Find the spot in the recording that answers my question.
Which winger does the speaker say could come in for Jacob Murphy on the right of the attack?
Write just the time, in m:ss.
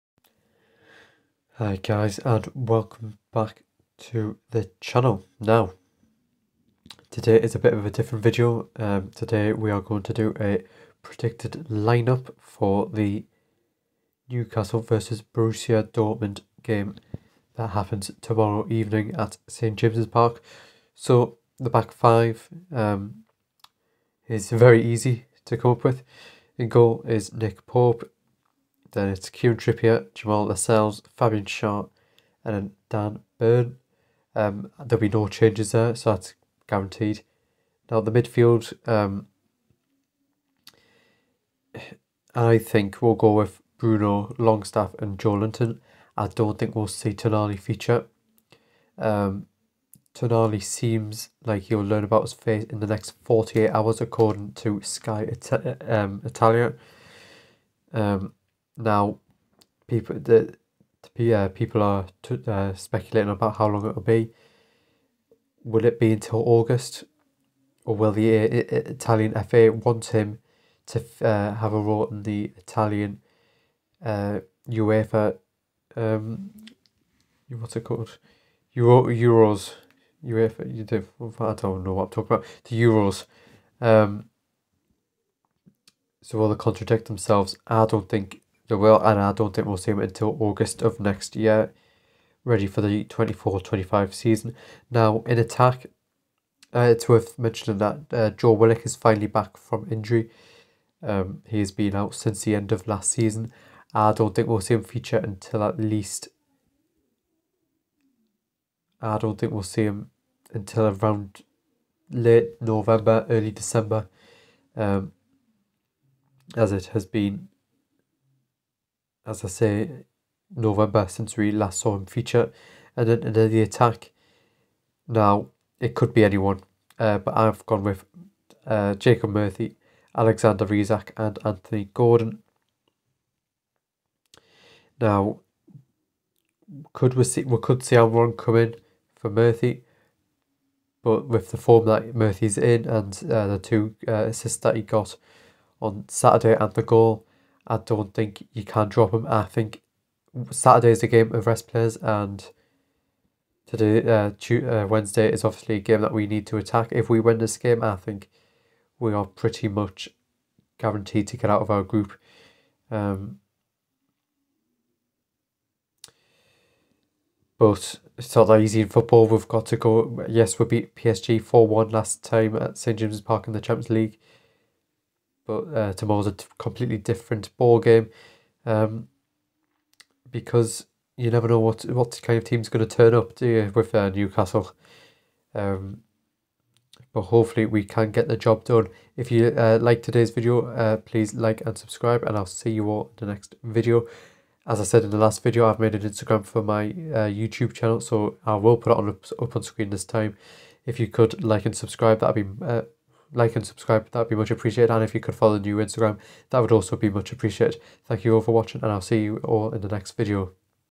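2:17.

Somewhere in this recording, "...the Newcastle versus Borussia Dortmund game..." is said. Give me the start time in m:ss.
0:12.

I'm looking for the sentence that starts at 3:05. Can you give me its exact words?
Um, but hopefully we can get the job done.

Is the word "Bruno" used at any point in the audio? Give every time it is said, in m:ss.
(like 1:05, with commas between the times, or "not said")
0:43.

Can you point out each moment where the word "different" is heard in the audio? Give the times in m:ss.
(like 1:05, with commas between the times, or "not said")
0:07, 2:56.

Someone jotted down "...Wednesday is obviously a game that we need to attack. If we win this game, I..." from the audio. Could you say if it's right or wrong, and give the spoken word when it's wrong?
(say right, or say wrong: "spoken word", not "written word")
right.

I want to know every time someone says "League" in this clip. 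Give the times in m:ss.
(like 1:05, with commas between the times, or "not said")
2:53.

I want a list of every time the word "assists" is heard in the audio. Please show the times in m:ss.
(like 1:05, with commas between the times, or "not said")
2:24.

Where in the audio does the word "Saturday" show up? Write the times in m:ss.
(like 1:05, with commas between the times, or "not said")
2:26, 2:30.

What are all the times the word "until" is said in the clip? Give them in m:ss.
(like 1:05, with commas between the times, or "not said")
1:06, 1:29, 1:45, 1:50.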